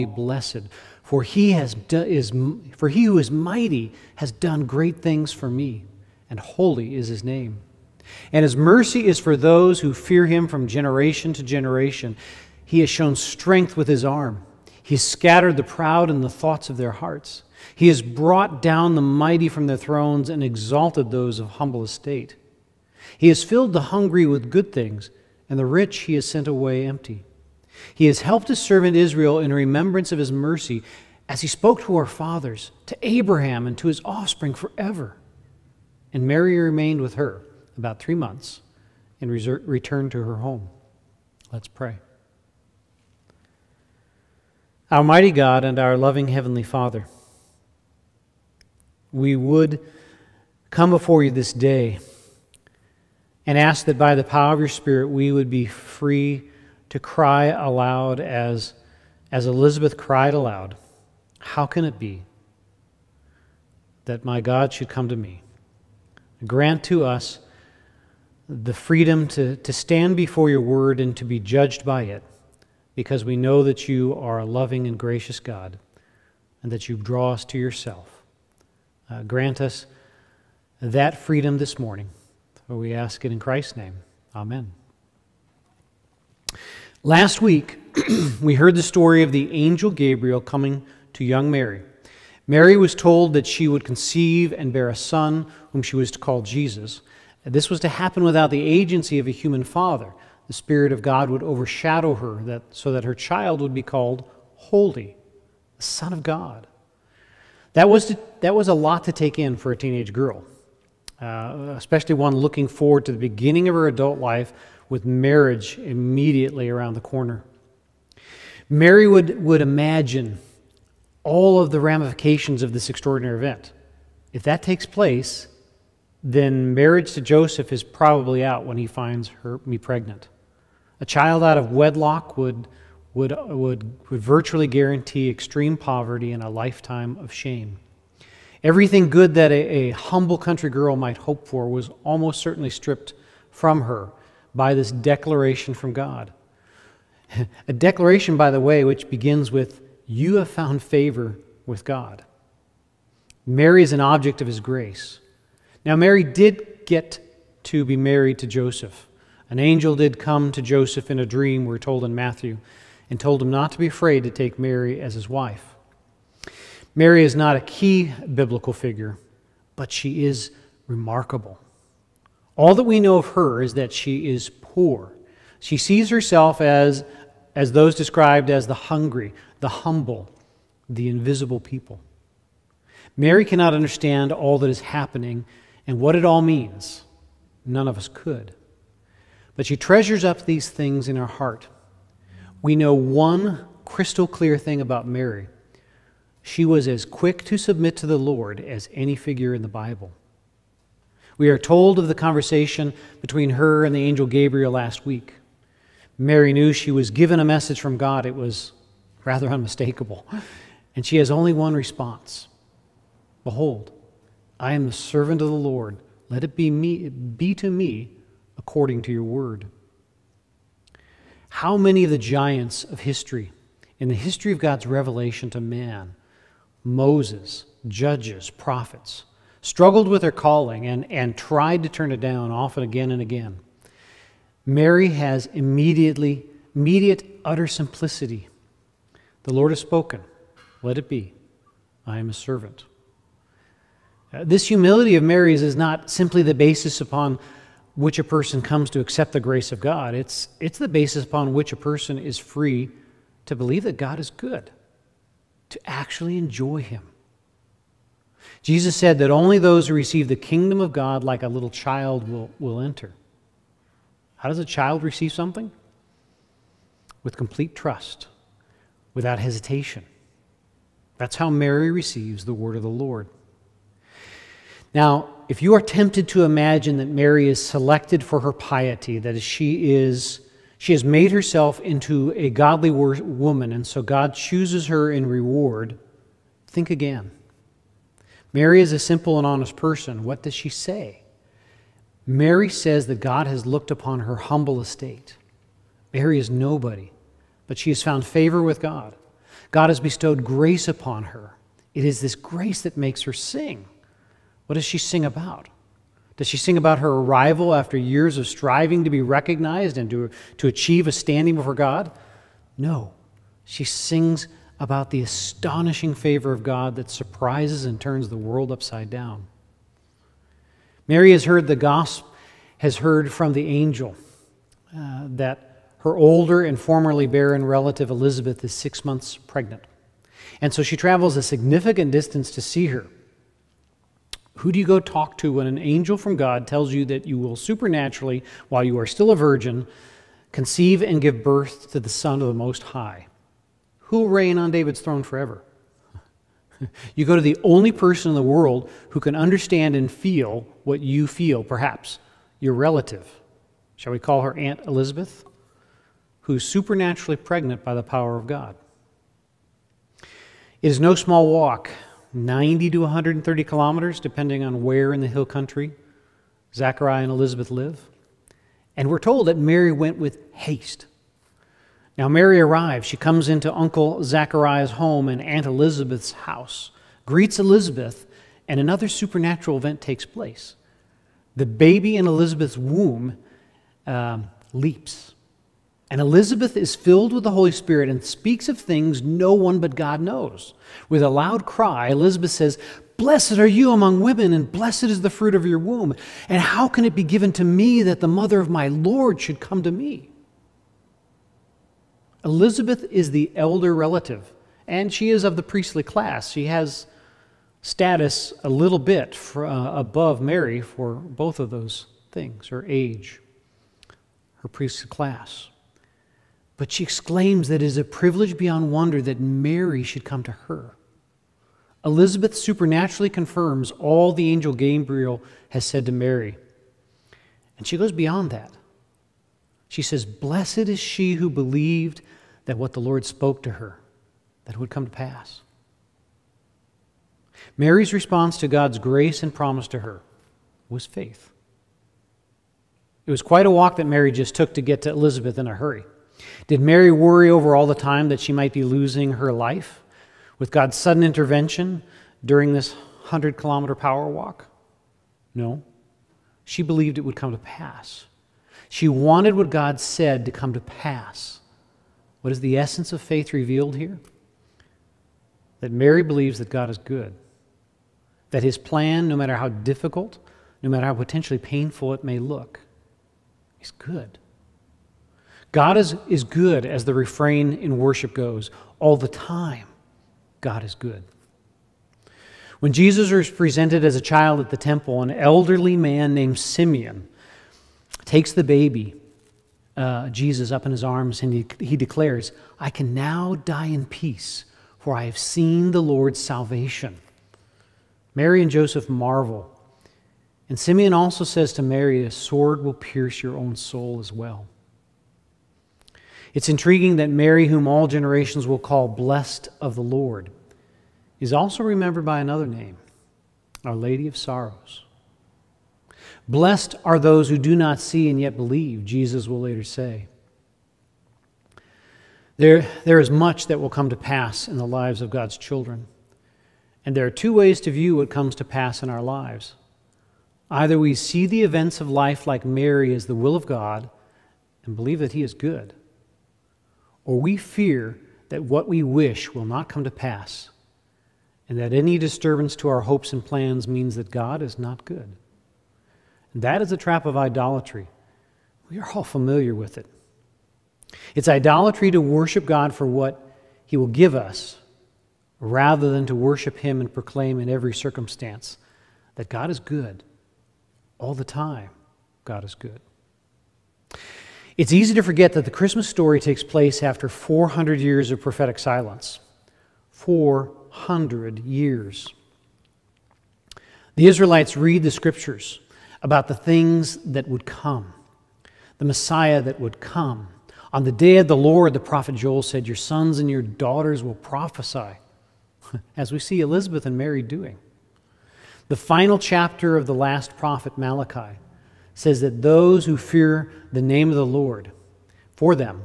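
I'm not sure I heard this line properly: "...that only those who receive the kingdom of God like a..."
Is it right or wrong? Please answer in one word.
right.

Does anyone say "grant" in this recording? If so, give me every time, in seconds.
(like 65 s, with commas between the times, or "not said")
66 s, 79 s.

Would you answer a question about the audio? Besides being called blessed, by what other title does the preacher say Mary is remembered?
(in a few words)
Our Lady of Sorrows.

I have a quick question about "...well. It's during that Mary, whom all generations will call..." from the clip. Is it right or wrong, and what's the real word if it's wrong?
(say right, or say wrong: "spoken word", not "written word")
wrong: "intriguing", not "during".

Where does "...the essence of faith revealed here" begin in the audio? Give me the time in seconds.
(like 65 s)
462 s.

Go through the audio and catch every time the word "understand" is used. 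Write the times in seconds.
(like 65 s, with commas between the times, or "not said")
183 s, 349 s.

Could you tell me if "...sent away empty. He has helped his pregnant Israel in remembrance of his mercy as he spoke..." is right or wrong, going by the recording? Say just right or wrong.
wrong.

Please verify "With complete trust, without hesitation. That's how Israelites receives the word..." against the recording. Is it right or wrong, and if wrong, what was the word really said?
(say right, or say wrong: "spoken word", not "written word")
wrong: "Mary", not "Israelites".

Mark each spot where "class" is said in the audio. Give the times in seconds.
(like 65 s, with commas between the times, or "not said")
406 s, 415 s.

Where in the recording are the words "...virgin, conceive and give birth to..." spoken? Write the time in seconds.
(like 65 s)
339 s.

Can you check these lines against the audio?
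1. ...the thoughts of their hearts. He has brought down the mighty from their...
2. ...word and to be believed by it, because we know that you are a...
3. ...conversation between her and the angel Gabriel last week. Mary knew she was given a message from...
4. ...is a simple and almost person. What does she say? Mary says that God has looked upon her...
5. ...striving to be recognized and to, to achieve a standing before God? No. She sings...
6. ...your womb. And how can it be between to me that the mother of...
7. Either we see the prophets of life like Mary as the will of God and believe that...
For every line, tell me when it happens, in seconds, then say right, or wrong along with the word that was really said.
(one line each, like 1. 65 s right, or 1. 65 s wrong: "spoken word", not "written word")
1. 16 s right
2. 70 s wrong: "judged", not "believed"
3. 202 s right
4. 288 s wrong: "honest", not "almost"
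5. 308 s right
6. 395 s wrong: "given", not "between"
7. 530 s wrong: "events", not "prophets".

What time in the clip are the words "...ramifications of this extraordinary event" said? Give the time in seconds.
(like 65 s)
121 s.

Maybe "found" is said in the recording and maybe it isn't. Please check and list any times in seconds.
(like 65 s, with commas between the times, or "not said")
150 s, 298 s.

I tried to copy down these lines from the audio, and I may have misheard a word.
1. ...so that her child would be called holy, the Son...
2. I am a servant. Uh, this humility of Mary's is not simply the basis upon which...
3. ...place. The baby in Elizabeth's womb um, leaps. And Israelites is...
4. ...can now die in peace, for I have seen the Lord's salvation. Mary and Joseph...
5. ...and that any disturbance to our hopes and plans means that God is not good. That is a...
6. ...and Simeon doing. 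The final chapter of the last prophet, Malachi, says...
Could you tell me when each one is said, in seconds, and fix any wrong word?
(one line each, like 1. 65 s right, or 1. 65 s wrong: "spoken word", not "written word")
1. 102 s right
2. 242 s right
3. 380 s wrong: "Elizabeth", not "Israelites"
4. 492 s right
5. 541 s right
6. 587 s wrong: "Mary", not "Simeon".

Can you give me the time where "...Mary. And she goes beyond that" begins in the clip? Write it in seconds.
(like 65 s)
426 s.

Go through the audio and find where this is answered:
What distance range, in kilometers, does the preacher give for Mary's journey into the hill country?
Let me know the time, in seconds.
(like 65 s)
362 s.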